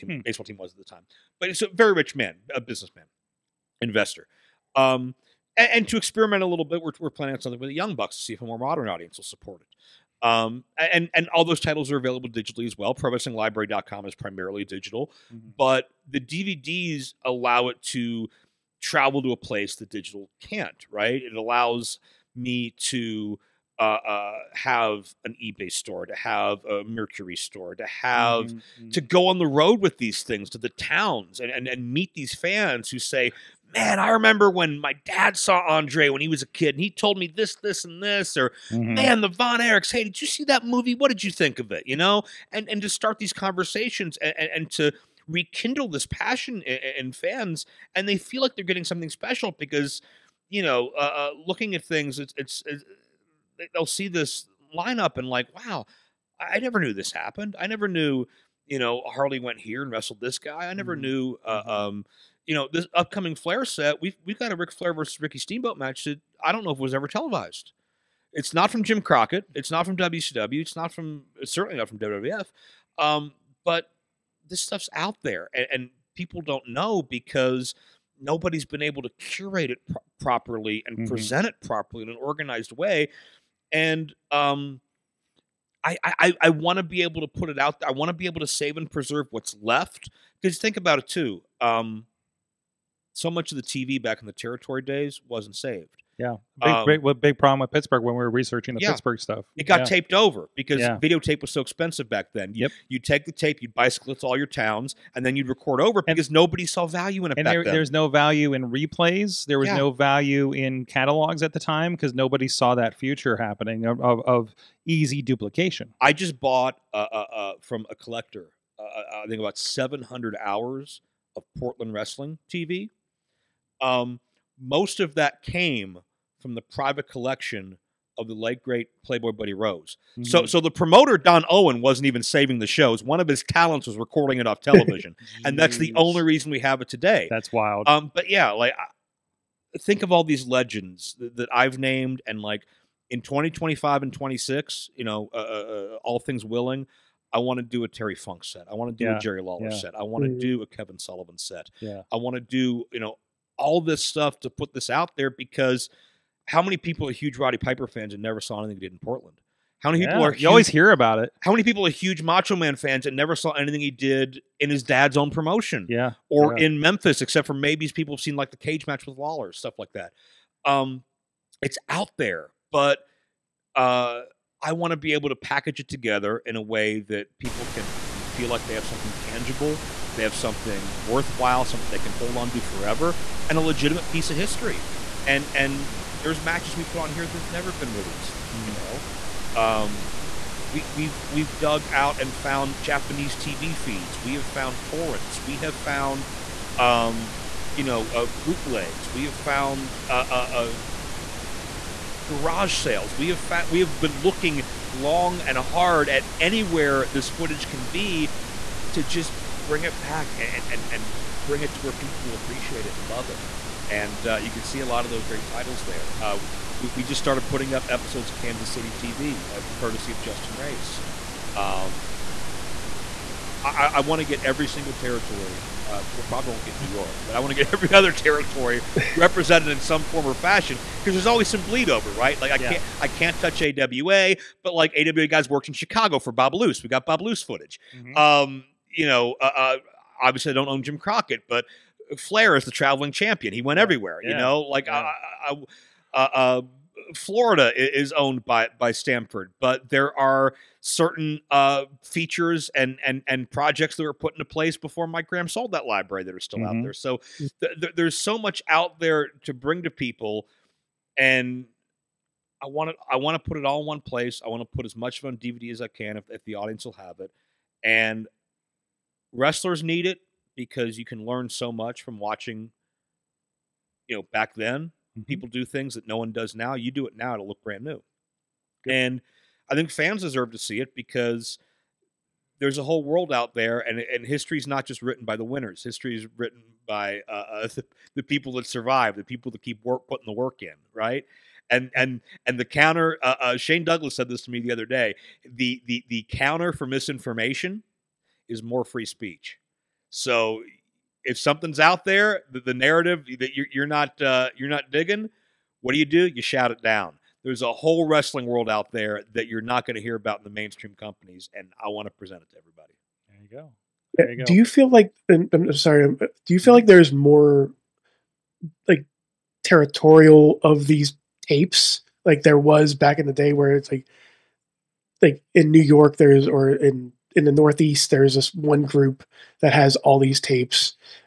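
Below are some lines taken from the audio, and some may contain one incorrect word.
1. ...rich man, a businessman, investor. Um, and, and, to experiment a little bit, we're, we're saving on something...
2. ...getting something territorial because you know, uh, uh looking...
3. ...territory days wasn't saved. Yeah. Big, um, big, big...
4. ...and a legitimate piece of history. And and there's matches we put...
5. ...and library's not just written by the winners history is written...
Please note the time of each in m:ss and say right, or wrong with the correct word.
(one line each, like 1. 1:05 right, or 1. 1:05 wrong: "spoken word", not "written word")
1. 0:01 wrong: "planning", not "saving"
2. 0:48 wrong: "special", not "territorial"
3. 1:34 right
4. 3:03 right
5. 4:43 wrong: "history", not "library".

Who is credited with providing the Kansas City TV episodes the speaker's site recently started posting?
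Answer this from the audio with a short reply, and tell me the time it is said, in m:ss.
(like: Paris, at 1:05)
Justin Race, at 3:40.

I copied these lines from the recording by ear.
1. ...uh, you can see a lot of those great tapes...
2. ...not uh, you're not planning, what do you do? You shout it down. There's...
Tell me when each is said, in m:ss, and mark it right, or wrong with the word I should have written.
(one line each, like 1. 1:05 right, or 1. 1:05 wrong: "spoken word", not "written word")
1. 3:34 wrong: "titles", not "tapes"
2. 5:03 wrong: "digging", not "planning".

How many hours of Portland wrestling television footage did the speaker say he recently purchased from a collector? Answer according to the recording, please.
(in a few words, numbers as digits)
700.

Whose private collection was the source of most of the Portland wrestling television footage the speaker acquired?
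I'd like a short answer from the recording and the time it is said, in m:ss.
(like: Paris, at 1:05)
Playboy Buddy Rose, at 2:09.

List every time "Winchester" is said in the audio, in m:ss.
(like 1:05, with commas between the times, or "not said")
not said.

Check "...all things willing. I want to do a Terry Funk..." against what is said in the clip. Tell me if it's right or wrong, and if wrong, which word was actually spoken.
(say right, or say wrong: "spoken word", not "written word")
right.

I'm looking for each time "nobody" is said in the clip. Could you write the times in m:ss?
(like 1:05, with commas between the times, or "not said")
1:18, 1:46, 1:52.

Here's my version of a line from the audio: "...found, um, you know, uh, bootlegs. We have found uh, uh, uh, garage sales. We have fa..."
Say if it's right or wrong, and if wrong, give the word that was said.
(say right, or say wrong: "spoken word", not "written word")
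right.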